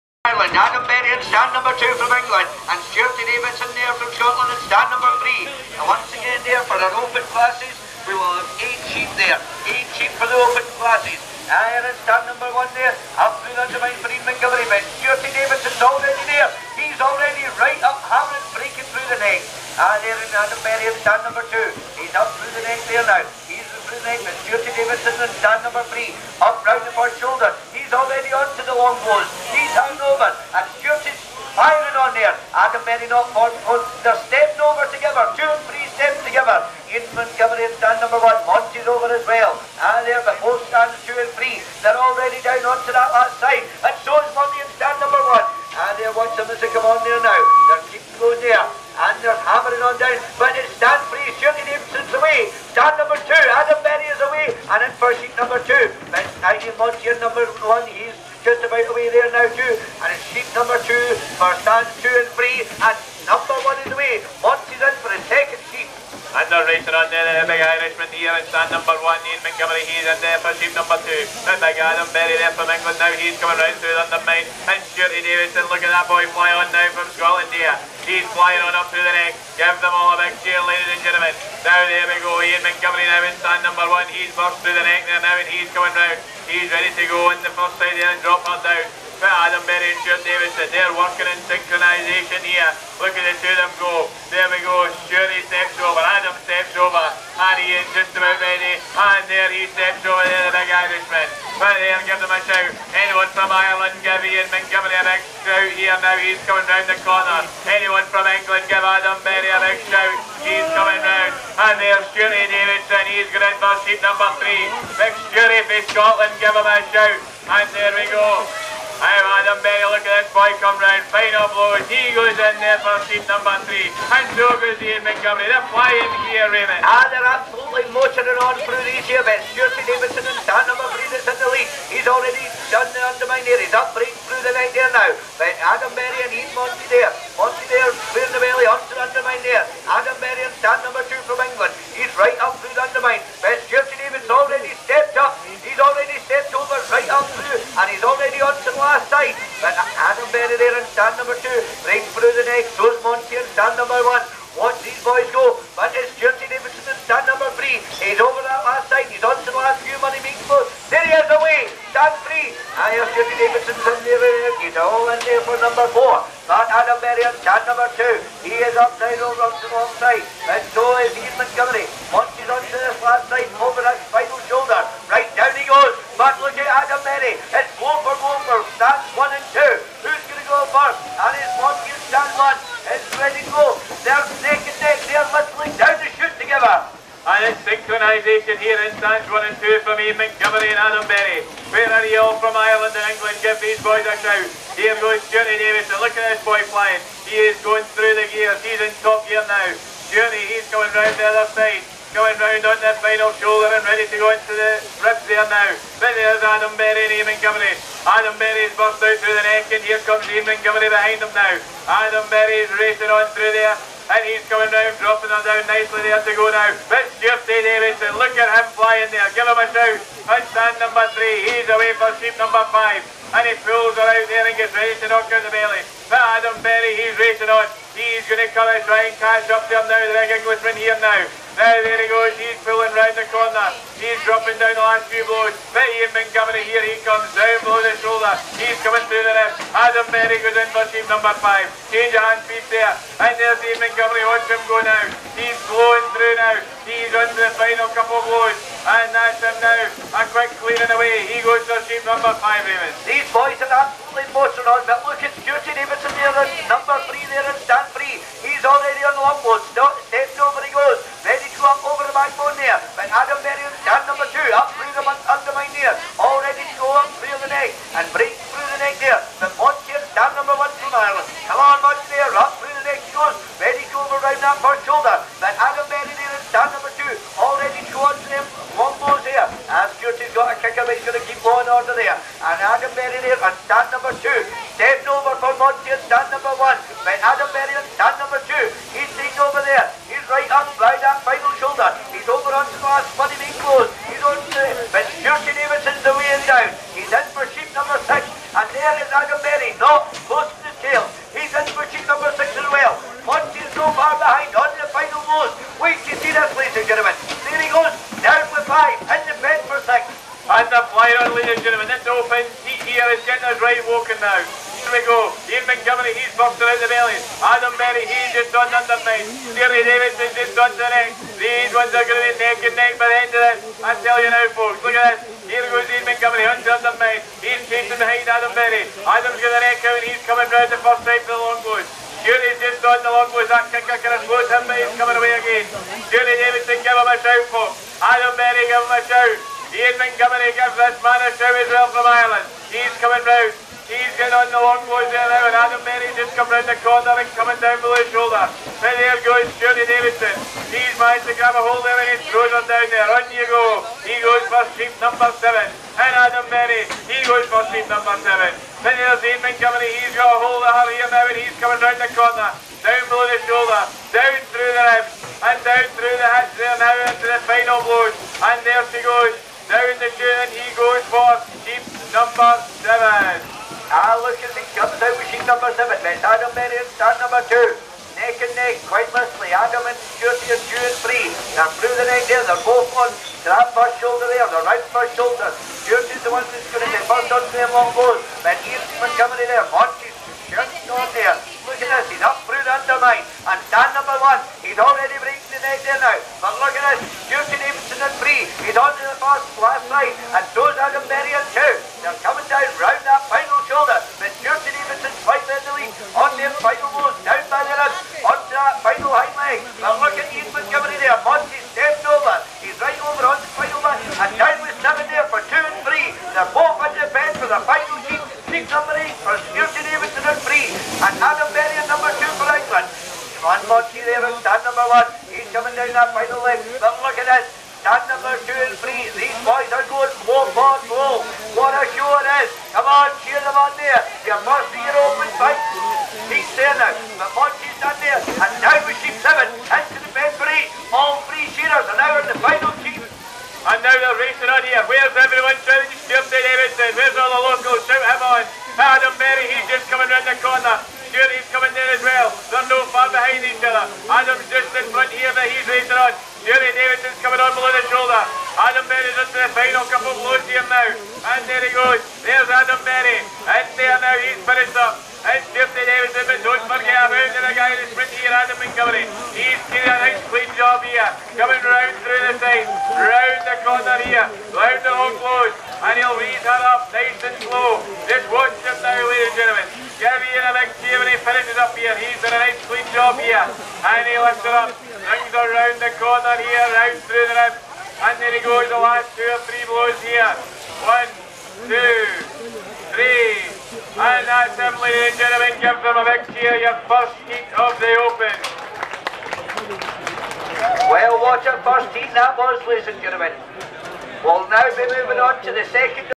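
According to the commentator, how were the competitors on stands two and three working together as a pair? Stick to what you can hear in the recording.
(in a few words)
In synchronisation.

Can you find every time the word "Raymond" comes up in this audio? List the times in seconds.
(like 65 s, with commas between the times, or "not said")
126 s, 252 s.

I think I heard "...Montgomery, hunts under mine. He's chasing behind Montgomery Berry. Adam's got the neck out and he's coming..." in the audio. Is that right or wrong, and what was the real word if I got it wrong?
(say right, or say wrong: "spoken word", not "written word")
wrong: "Adam", not "Montgomery".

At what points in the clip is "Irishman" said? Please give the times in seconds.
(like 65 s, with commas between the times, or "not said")
67 s, 100 s.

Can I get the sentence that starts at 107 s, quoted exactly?
Anyone from England, give Adam Berry a big shout, he's coming round.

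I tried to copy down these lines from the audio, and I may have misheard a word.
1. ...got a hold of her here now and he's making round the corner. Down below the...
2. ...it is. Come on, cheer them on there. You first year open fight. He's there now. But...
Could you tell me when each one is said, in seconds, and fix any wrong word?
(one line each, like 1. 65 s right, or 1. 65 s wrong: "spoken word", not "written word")
1. 360 s wrong: "coming", not "making"
2. 432 s right.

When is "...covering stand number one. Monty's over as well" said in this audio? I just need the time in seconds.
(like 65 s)
37 s.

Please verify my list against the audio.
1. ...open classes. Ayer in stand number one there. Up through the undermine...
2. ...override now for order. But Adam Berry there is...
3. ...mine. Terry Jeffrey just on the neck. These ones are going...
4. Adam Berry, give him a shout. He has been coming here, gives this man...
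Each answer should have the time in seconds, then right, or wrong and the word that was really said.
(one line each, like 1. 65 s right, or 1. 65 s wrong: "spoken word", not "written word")
1. 10 s wrong: "divine", not "undermine"
2. 274 s wrong: "shoulder", not "order"
3. 319 s wrong: "Davidson", not "Jeffrey"
4. 338 s right.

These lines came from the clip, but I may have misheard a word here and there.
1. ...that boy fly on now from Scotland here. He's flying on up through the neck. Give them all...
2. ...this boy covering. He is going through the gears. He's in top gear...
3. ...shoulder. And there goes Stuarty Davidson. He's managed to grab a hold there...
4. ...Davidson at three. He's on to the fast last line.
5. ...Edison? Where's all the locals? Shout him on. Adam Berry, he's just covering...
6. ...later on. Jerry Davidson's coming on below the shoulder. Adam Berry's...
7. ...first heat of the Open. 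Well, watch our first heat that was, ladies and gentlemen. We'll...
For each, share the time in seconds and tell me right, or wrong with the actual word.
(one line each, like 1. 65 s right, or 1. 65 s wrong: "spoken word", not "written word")
1. 75 s right
2. 196 s wrong: "flying", not "covering"
3. 348 s right
4. 397 s right
5. 446 s wrong: "coming", not "covering"
6. 455 s right
7. 496 s right.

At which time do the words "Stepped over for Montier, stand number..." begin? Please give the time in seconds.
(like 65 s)
284 s.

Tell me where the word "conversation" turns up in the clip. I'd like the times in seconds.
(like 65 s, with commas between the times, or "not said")
not said.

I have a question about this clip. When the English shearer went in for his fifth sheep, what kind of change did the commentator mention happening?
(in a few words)
Change of hand feed.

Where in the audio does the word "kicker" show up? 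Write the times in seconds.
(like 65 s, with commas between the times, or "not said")
280 s, 333 s.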